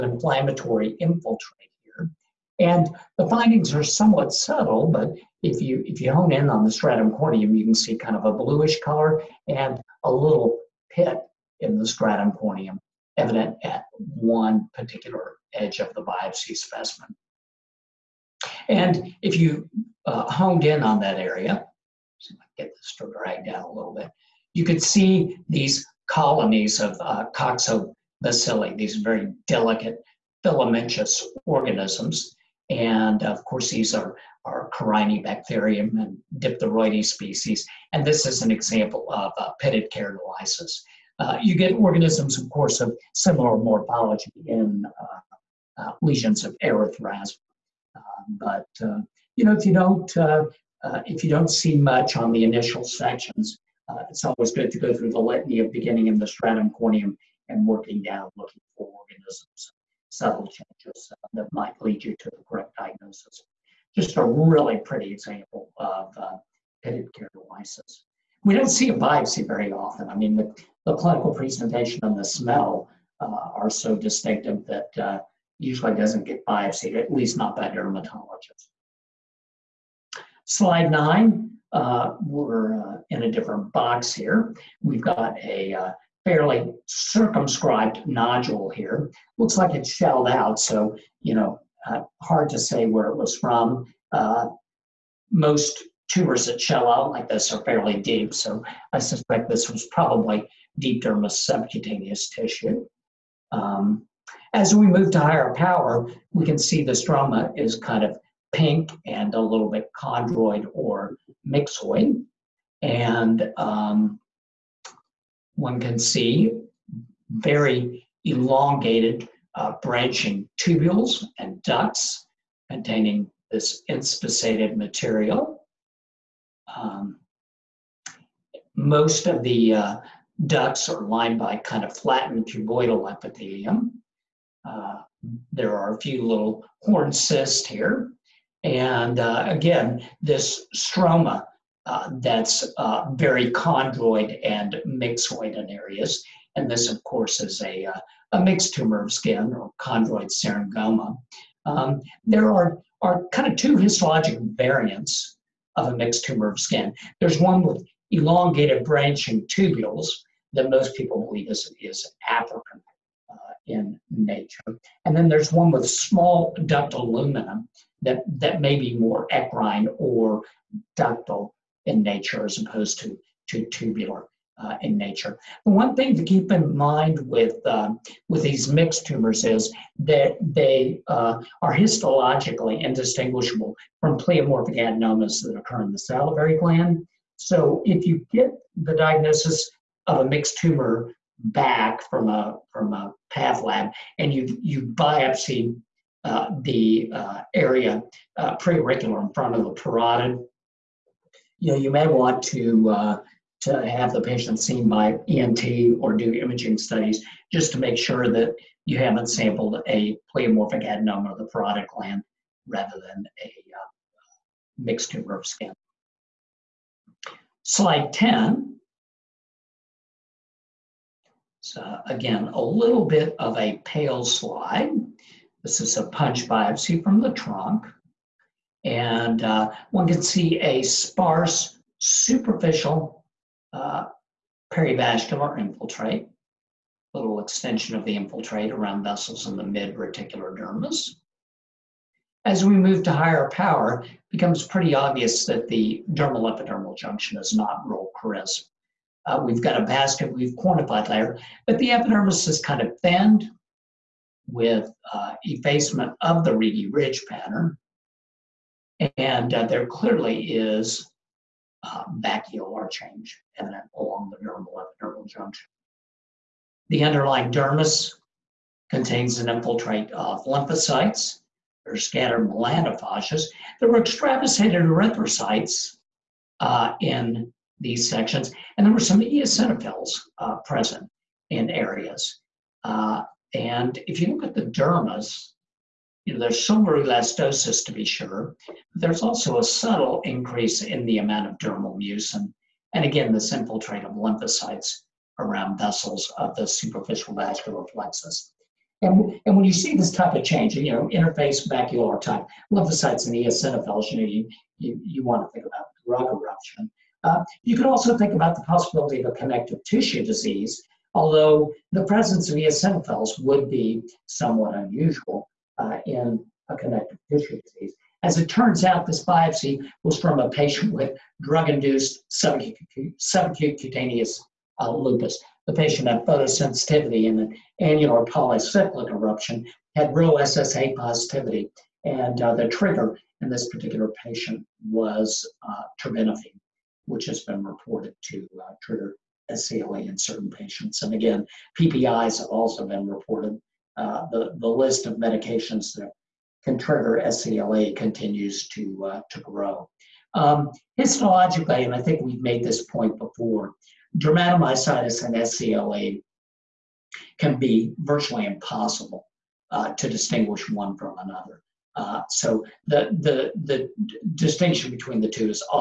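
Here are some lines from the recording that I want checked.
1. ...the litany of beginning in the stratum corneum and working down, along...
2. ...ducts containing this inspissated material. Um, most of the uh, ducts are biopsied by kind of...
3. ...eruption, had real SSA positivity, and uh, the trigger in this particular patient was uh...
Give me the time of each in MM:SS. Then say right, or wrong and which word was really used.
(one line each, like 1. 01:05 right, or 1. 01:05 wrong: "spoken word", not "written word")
1. 00:55 wrong: "looking", not "along"
2. 02:01 wrong: "lined", not "biopsied"
3. 05:29 right.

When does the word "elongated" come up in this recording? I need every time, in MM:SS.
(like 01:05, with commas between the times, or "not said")
01:58, 02:38.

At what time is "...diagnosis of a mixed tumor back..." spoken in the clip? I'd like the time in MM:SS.
03:08.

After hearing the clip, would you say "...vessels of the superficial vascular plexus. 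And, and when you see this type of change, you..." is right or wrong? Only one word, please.
right.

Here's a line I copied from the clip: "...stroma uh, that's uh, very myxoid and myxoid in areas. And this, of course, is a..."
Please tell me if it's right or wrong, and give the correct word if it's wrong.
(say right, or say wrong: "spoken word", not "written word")
wrong: "chondroid", not "myxoid".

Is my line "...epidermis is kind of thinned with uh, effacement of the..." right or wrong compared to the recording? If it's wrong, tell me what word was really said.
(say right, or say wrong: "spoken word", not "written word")
right.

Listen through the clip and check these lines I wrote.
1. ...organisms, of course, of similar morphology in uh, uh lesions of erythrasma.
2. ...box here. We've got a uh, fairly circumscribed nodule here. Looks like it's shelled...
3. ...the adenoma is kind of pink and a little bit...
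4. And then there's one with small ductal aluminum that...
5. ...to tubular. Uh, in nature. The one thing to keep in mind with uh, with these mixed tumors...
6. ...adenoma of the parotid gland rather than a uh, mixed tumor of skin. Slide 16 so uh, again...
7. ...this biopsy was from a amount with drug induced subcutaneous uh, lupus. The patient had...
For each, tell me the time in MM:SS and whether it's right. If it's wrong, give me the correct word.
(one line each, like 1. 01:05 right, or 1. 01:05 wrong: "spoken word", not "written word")
1. 00:41 right
2. 01:23 right
3. 01:46 wrong: "stroma", not "adenoma"
4. 02:45 right
5. 02:53 right
6. 03:30 wrong: "10", not "16"
7. 05:19 wrong: "patient", not "amount".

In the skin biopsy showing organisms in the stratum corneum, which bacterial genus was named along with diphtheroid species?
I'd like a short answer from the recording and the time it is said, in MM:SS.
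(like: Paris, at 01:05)
Corynebacterium, at 00:34.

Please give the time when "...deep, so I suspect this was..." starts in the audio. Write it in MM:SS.
01:37.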